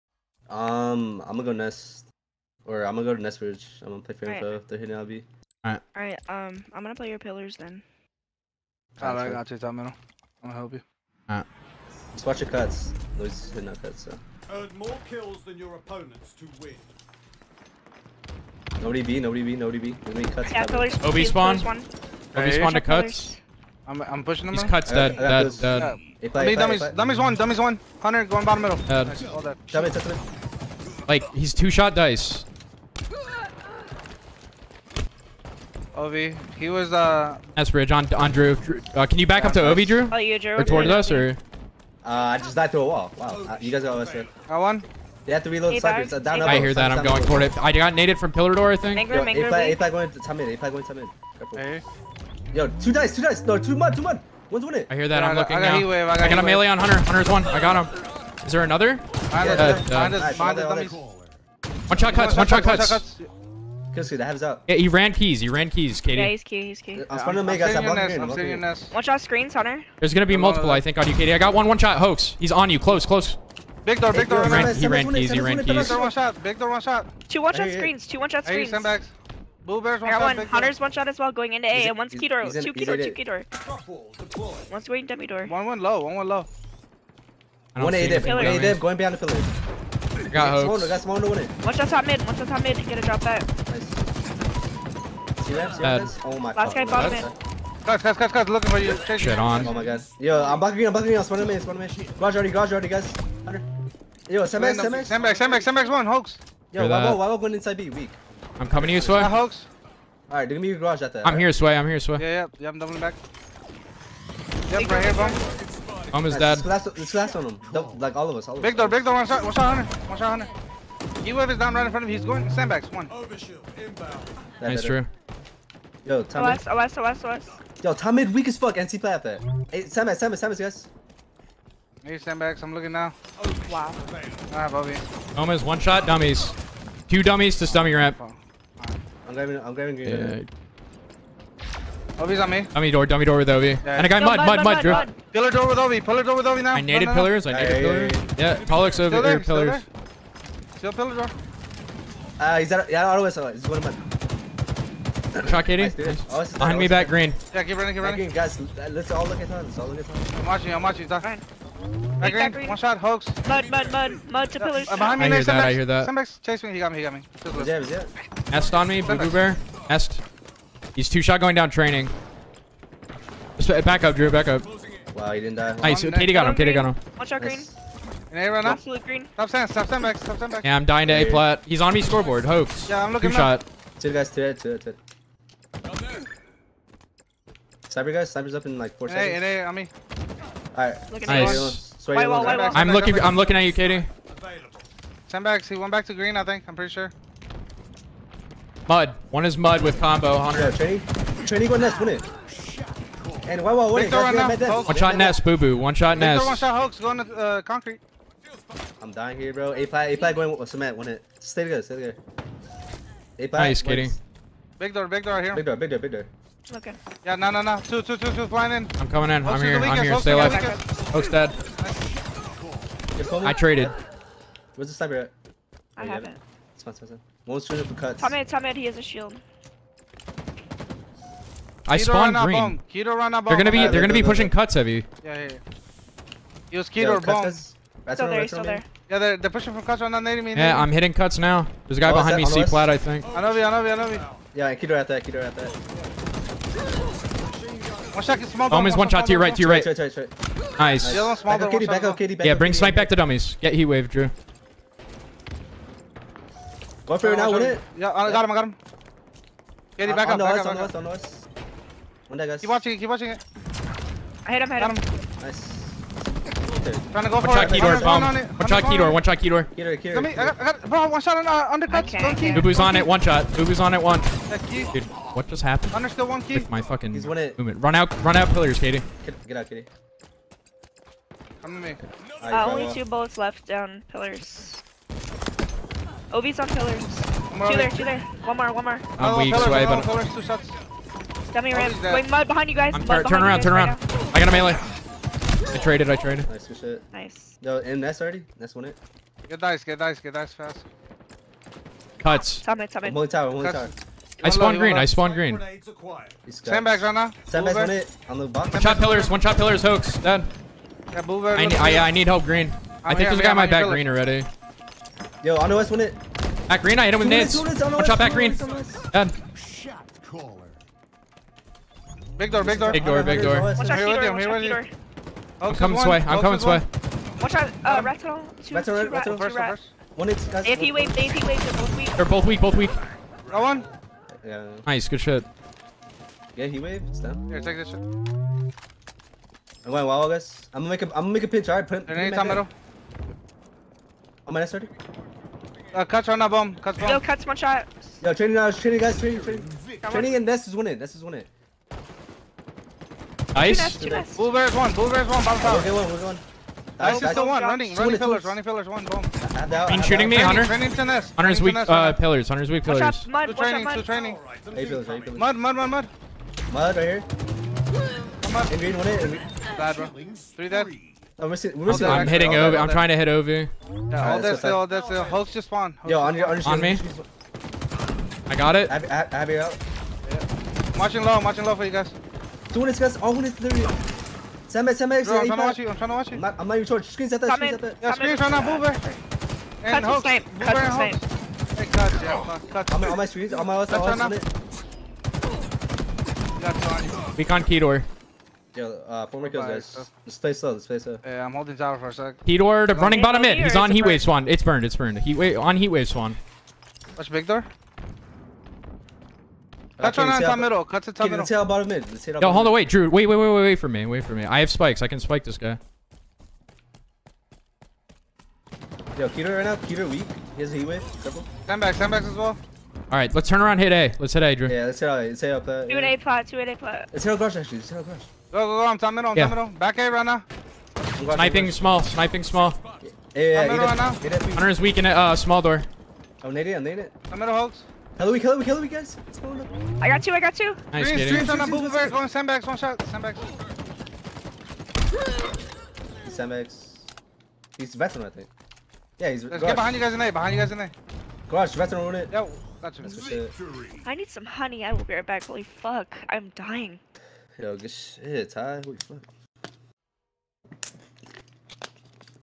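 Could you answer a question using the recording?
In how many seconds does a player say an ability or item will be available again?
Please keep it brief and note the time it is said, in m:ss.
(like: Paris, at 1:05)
4, at 3:08.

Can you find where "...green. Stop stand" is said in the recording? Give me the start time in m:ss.
2:59.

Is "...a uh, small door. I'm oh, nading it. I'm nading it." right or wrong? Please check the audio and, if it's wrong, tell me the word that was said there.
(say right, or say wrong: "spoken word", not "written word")
right.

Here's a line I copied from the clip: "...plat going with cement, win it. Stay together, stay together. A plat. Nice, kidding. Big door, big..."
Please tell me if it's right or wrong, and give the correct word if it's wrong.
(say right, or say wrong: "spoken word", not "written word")
right.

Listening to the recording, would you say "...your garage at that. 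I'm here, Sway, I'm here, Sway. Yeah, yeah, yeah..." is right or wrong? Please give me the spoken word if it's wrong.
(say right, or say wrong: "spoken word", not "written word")
right.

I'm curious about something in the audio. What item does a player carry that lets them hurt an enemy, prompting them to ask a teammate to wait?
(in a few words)
spikes.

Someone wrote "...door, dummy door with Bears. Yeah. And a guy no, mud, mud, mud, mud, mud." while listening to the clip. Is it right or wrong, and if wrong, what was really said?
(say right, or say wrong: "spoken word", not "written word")
wrong: "Ovi", not "Bears".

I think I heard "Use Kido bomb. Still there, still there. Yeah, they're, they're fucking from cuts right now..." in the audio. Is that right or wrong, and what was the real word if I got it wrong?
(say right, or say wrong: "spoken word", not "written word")
wrong: "pushing", not "fucking".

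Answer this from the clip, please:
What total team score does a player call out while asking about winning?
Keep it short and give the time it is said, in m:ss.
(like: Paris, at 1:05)
140, at 4:17.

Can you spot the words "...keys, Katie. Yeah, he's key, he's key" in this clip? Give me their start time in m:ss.
1:05.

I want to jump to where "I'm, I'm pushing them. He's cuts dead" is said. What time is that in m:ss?
0:23.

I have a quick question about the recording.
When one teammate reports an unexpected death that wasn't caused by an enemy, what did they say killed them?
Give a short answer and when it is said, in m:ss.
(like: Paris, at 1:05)
a wall, at 0:42.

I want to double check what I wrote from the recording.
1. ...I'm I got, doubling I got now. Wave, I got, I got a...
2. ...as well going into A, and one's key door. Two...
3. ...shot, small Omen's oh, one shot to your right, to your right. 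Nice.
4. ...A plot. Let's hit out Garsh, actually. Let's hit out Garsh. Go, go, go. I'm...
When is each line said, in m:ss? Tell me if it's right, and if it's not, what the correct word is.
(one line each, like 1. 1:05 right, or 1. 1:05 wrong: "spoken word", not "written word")
1. 0:55 wrong: "looking", not "doubling"
2. 1:21 right
3. 4:08 right
4. 7:06 right.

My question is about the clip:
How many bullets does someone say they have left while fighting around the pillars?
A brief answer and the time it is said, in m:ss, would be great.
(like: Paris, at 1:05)
2, at 4:42.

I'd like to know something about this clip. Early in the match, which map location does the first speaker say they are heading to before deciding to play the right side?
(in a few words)
Nesbridge.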